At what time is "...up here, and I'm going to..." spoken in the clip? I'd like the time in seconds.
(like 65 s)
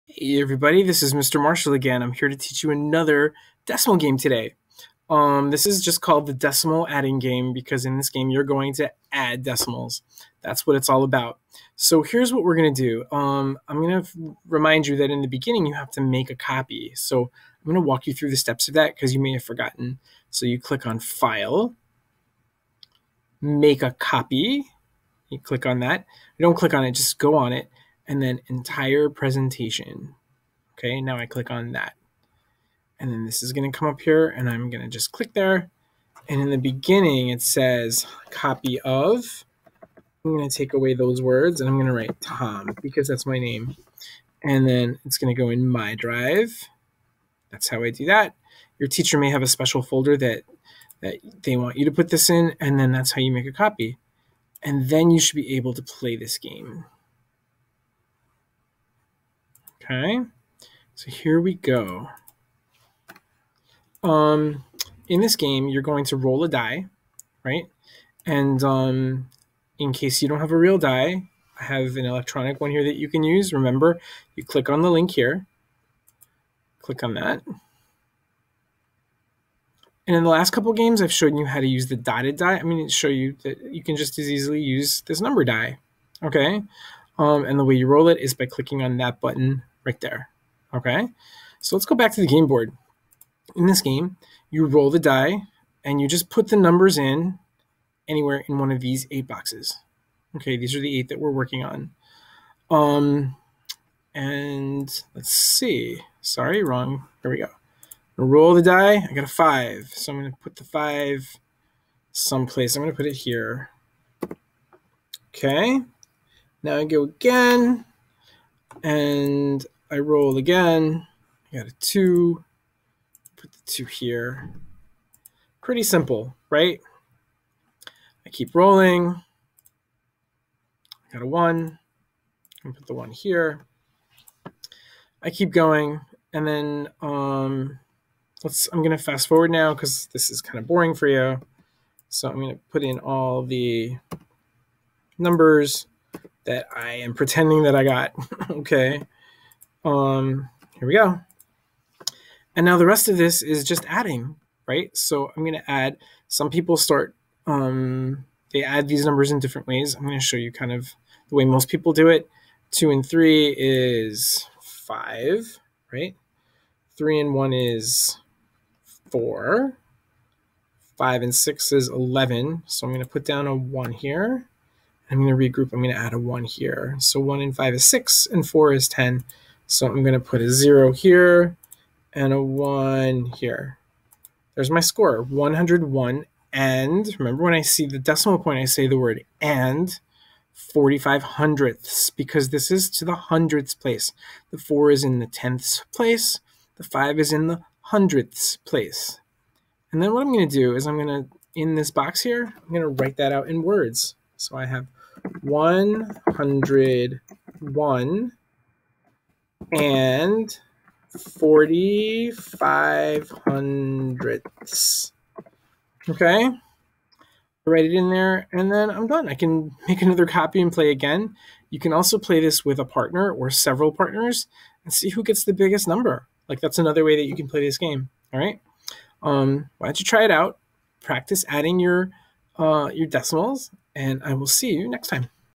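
33 s.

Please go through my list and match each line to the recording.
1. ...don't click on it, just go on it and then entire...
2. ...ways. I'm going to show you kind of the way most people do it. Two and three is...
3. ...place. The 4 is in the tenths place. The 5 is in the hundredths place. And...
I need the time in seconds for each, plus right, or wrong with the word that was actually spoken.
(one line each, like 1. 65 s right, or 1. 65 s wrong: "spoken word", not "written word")
1. 26 s right
2. 159 s right
3. 193 s right.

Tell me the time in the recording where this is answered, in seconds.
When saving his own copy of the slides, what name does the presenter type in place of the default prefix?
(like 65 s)
42 s.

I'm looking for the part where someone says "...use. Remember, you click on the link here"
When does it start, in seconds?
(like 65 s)
73 s.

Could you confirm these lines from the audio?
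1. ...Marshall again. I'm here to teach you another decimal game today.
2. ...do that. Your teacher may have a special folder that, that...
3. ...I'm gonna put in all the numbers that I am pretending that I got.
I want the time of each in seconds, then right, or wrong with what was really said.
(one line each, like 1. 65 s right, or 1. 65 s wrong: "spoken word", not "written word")
1. 1 s right
2. 47 s right
3. 142 s right.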